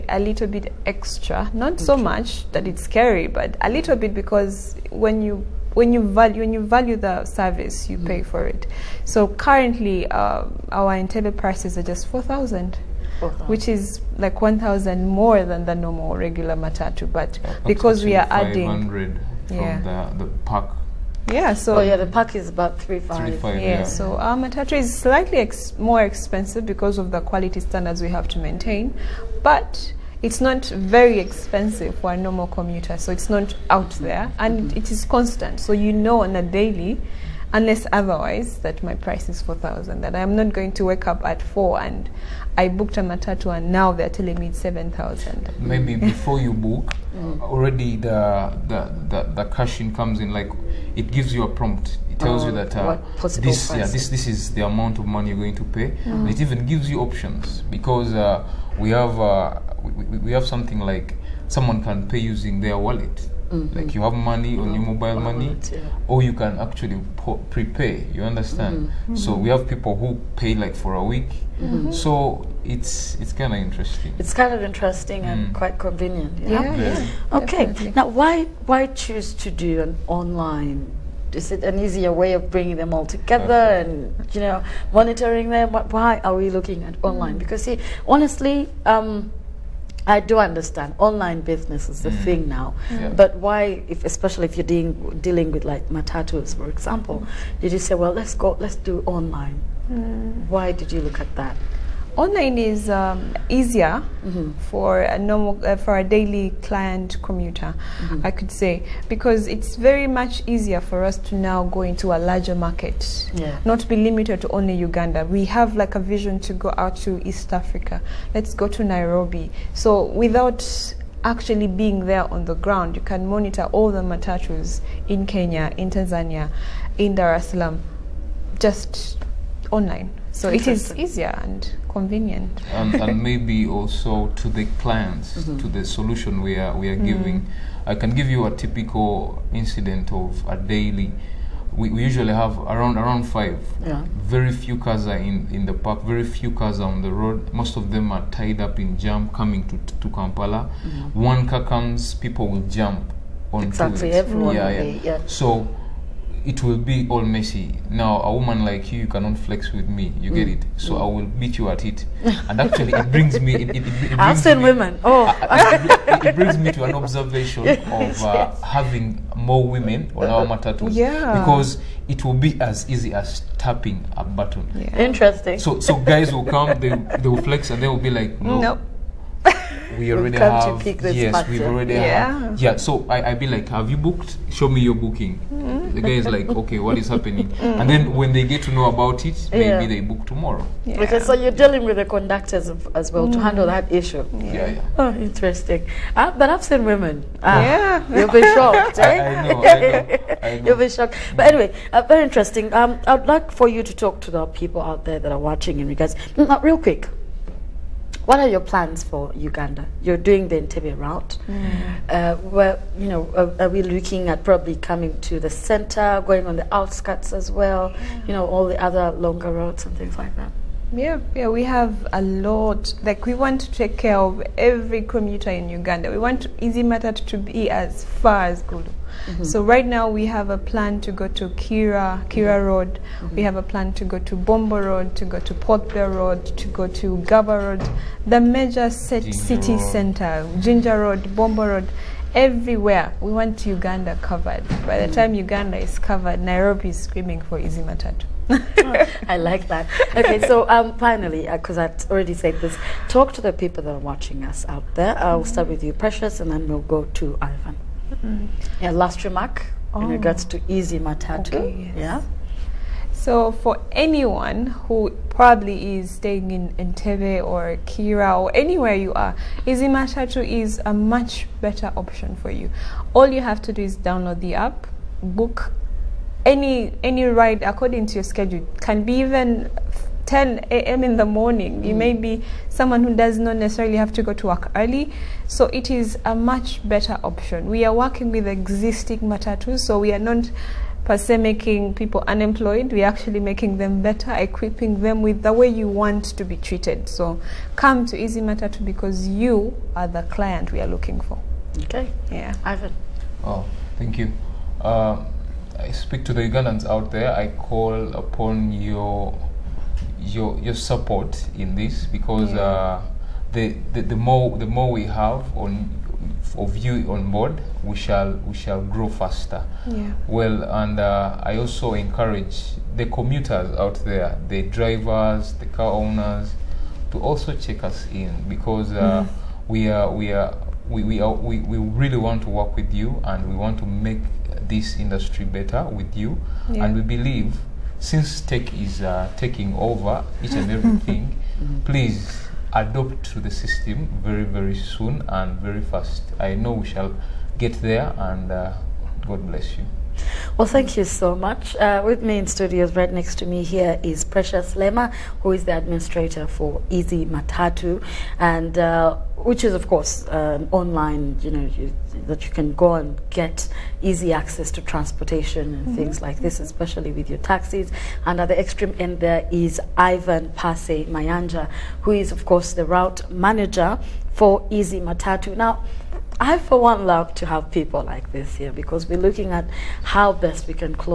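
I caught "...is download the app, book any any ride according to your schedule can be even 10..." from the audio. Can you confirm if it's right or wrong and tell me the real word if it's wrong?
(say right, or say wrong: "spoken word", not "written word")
right.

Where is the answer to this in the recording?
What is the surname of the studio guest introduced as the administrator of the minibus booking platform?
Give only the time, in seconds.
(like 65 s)
354 s.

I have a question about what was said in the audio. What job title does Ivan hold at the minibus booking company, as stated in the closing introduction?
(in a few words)
Route manager.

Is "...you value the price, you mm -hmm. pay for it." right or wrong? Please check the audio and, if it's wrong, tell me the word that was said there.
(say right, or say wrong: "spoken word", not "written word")
wrong: "service", not "price".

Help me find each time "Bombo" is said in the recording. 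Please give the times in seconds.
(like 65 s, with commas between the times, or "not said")
234 s, 241 s.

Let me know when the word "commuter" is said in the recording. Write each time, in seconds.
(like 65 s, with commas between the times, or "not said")
32 s, 107 s, 225 s, 323 s.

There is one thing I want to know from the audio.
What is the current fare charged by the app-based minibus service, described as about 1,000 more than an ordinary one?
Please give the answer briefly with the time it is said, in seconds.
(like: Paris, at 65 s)
4000, at 12 s.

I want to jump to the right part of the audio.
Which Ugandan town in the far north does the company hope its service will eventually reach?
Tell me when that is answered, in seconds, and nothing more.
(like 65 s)
228 s.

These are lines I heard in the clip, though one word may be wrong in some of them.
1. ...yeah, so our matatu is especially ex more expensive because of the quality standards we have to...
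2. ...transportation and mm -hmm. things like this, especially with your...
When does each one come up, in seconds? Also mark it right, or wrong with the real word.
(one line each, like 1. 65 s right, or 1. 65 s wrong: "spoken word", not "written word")
1. 23 s wrong: "slightly", not "especially"
2. 364 s right.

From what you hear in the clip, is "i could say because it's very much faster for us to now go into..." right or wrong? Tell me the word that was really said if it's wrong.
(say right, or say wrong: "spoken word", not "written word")
wrong: "easier", not "faster".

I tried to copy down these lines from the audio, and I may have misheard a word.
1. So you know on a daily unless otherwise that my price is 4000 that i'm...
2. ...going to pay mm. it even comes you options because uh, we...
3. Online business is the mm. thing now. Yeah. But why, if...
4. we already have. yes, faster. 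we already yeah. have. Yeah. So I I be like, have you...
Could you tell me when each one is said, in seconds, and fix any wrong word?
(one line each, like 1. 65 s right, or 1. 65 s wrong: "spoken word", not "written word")
1. 35 s right
2. 55 s wrong: "gives", not "comes"
3. 90 s right
4. 179 s wrong: "master", not "faster".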